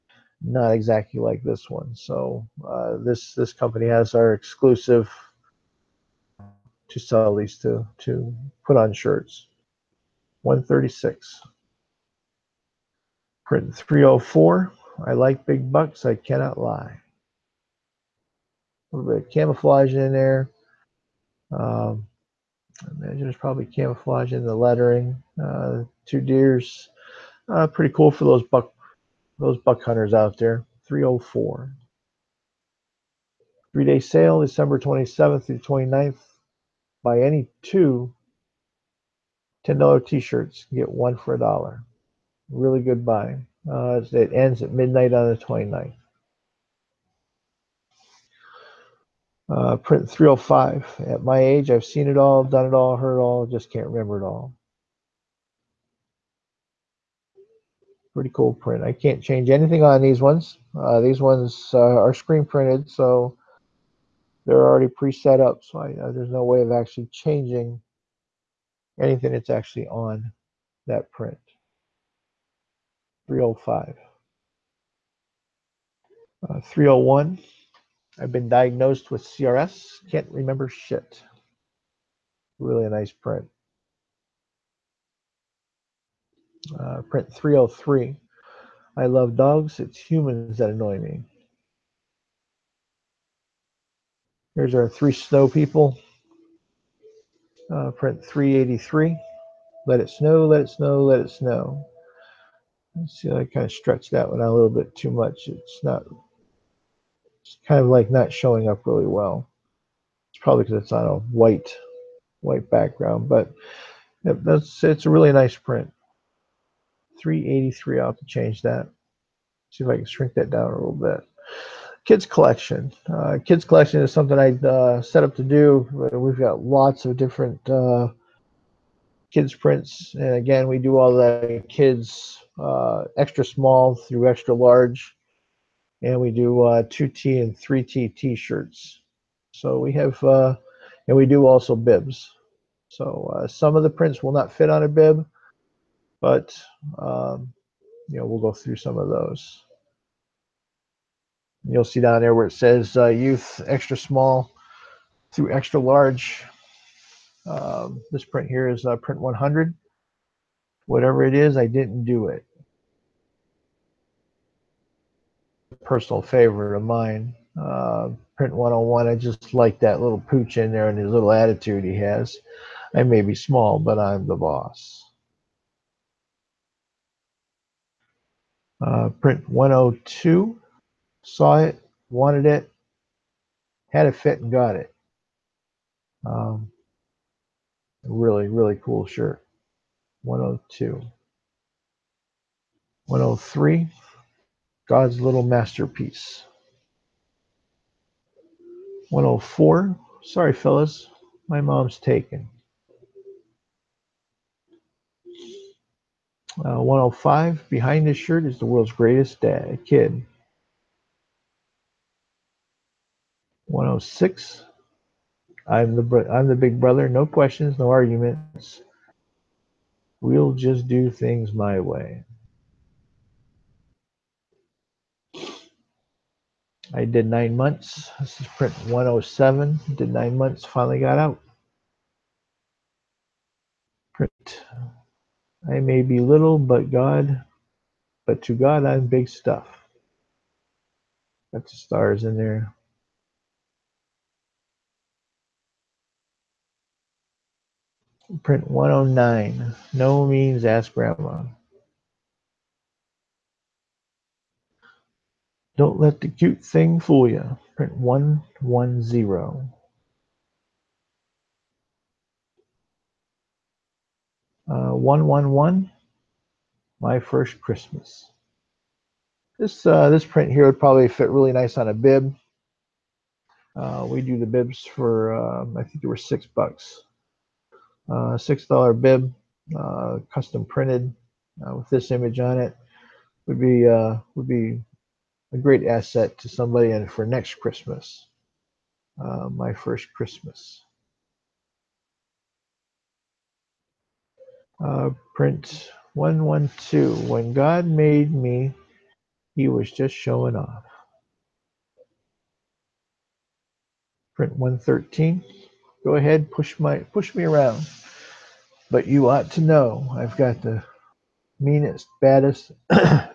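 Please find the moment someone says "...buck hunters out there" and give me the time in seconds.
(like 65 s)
29 s.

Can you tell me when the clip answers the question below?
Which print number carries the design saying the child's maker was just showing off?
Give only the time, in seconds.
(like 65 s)
296 s.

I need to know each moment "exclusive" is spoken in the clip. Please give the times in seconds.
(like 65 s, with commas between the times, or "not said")
4 s.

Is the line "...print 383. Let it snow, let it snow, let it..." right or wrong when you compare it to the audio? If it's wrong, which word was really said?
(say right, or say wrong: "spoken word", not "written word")
right.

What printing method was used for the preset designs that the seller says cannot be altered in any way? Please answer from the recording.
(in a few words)
screen printed.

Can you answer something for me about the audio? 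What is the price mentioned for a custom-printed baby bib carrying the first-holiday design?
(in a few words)
$6.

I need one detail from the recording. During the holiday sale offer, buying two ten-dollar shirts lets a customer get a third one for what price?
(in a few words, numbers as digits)
$1.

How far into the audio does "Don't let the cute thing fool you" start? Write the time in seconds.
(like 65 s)
255 s.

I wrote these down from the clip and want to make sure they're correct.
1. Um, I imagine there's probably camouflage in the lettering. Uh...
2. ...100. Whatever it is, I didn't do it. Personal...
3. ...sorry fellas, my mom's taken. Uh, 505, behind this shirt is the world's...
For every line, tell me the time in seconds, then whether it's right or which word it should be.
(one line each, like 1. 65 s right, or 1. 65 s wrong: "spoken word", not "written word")
1. 21 s right
2. 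159 s right
3. 200 s wrong: "105", not "505".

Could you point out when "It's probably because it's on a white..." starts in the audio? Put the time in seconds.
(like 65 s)
110 s.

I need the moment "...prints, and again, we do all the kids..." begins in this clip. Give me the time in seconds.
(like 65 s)
129 s.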